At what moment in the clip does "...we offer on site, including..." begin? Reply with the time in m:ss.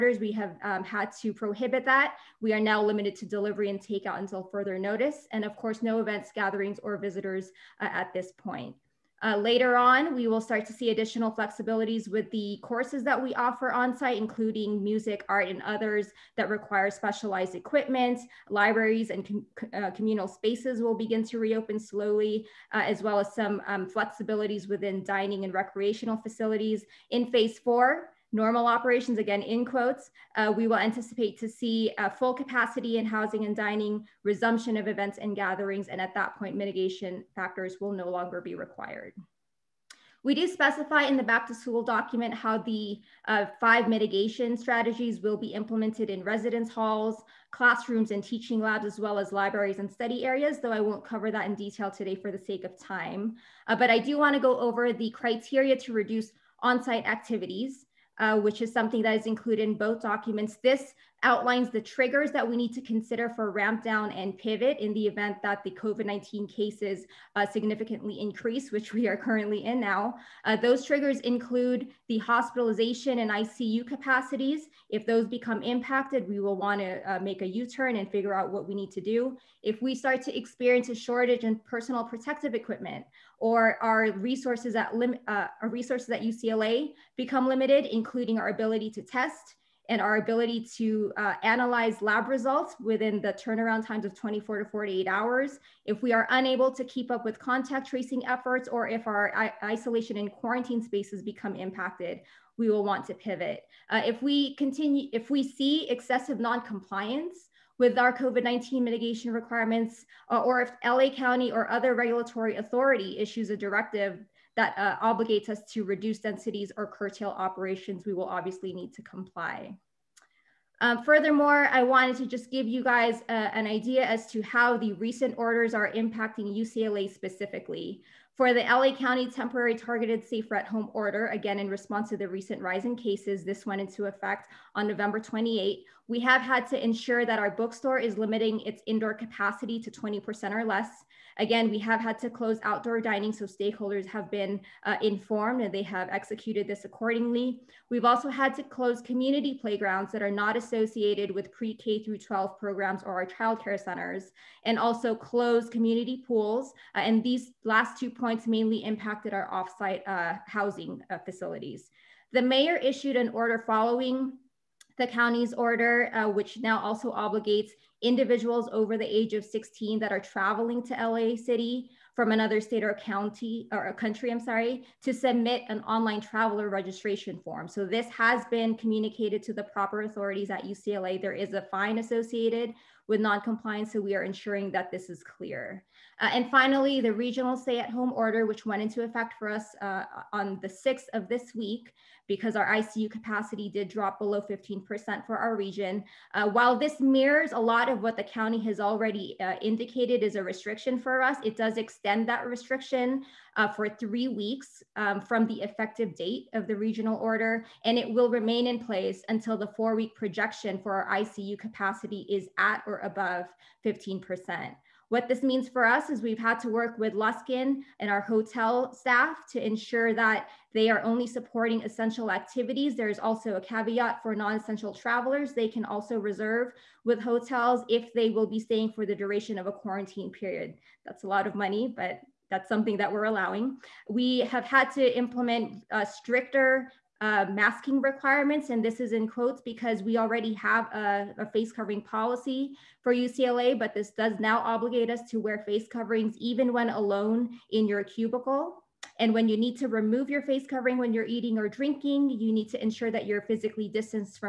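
0:13.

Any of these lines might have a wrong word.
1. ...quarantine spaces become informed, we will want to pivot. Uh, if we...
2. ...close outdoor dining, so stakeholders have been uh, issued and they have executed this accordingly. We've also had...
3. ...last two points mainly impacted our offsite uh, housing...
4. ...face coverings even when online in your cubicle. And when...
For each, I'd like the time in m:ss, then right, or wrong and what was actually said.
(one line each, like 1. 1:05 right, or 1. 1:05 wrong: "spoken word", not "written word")
1. 1:40 wrong: "impacted", not "informed"
2. 2:22 wrong: "informed", not "issued"
3. 2:37 right
4. 4:05 wrong: "alone", not "online".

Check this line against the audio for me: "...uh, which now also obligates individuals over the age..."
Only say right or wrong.
right.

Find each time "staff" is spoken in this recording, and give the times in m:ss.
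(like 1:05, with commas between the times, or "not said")
3:38.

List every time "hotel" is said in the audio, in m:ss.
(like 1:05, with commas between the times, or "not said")
3:38, 3:47.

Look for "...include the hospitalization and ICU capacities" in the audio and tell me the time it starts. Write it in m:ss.
1:11.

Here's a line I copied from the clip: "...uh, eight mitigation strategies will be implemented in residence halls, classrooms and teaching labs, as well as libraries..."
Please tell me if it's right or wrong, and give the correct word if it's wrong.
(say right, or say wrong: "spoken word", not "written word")
wrong: "five", not "eight".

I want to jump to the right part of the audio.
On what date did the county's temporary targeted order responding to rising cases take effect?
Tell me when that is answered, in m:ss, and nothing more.
2:14.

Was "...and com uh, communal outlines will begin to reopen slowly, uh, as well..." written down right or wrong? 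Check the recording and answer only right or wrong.
wrong.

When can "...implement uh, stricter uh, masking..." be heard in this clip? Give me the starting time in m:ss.
3:55.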